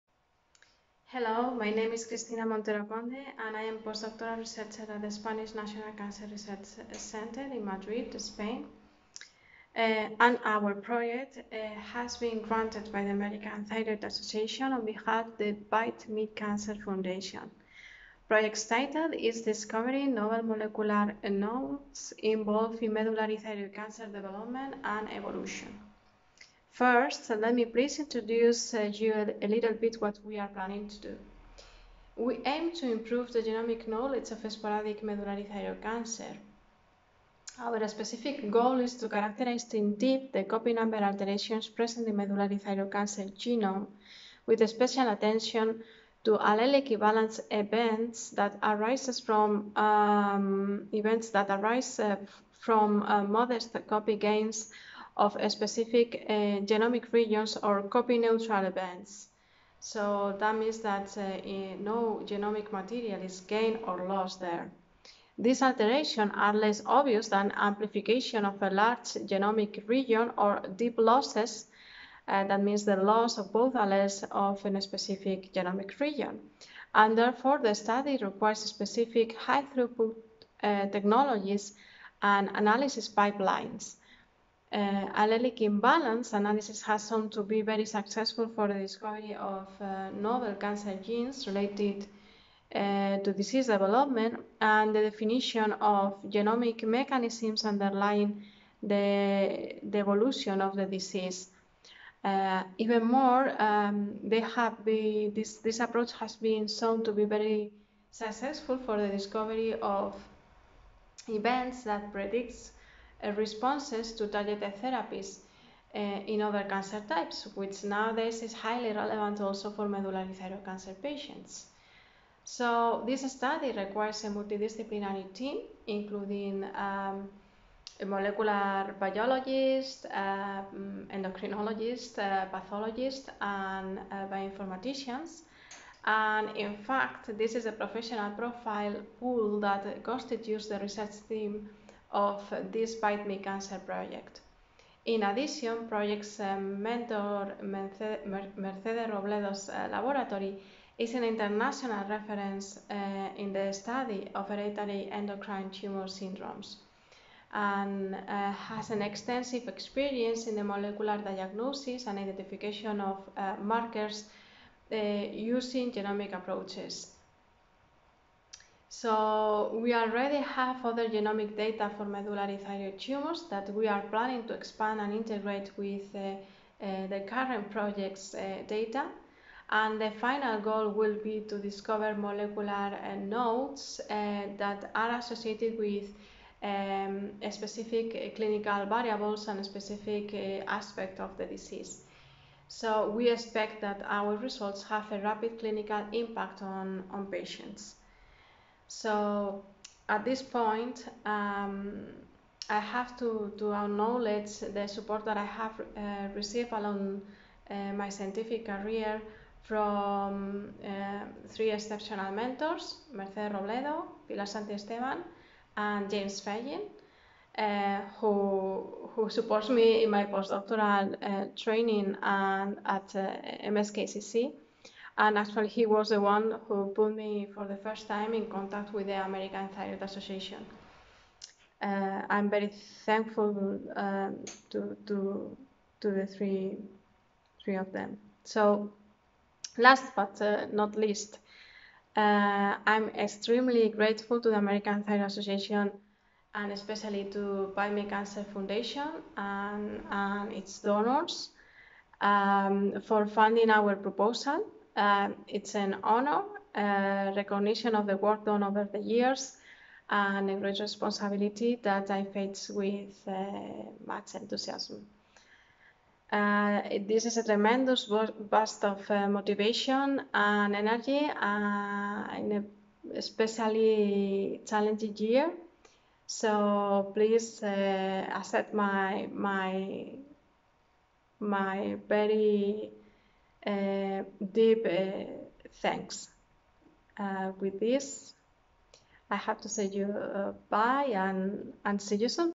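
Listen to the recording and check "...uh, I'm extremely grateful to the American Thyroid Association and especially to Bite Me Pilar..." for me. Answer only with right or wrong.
wrong.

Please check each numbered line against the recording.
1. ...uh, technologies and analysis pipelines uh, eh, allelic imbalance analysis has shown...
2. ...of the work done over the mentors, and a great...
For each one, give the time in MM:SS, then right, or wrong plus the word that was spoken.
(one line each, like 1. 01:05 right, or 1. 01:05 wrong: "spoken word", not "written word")
1. 01:20 right
2. 04:17 wrong: "years", not "mentors".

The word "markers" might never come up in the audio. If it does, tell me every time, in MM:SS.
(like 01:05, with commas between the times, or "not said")
02:43.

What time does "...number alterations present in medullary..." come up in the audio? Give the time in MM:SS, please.
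00:40.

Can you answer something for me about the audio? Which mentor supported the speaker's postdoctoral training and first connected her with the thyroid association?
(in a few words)
James Fagin.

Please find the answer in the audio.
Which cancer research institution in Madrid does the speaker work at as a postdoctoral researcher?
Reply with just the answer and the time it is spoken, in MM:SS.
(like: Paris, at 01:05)
Spanish National Cancer Research Center, at 00:05.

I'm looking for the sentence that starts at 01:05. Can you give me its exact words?
These alterations are less obvious than amplification of a large genomic region or deep losses.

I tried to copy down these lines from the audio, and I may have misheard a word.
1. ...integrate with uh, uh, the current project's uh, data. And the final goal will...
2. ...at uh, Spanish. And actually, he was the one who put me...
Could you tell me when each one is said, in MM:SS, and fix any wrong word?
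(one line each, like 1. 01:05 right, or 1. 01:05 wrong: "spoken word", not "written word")
1. 02:55 right
2. 03:42 wrong: "MSKCC", not "Spanish".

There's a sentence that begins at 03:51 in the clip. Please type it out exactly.
Uh, I'm very thankful um, to, to, to the three, three of them.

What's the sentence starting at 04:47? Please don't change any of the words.
Uh, with this, I have to say you bye and, and see you soon.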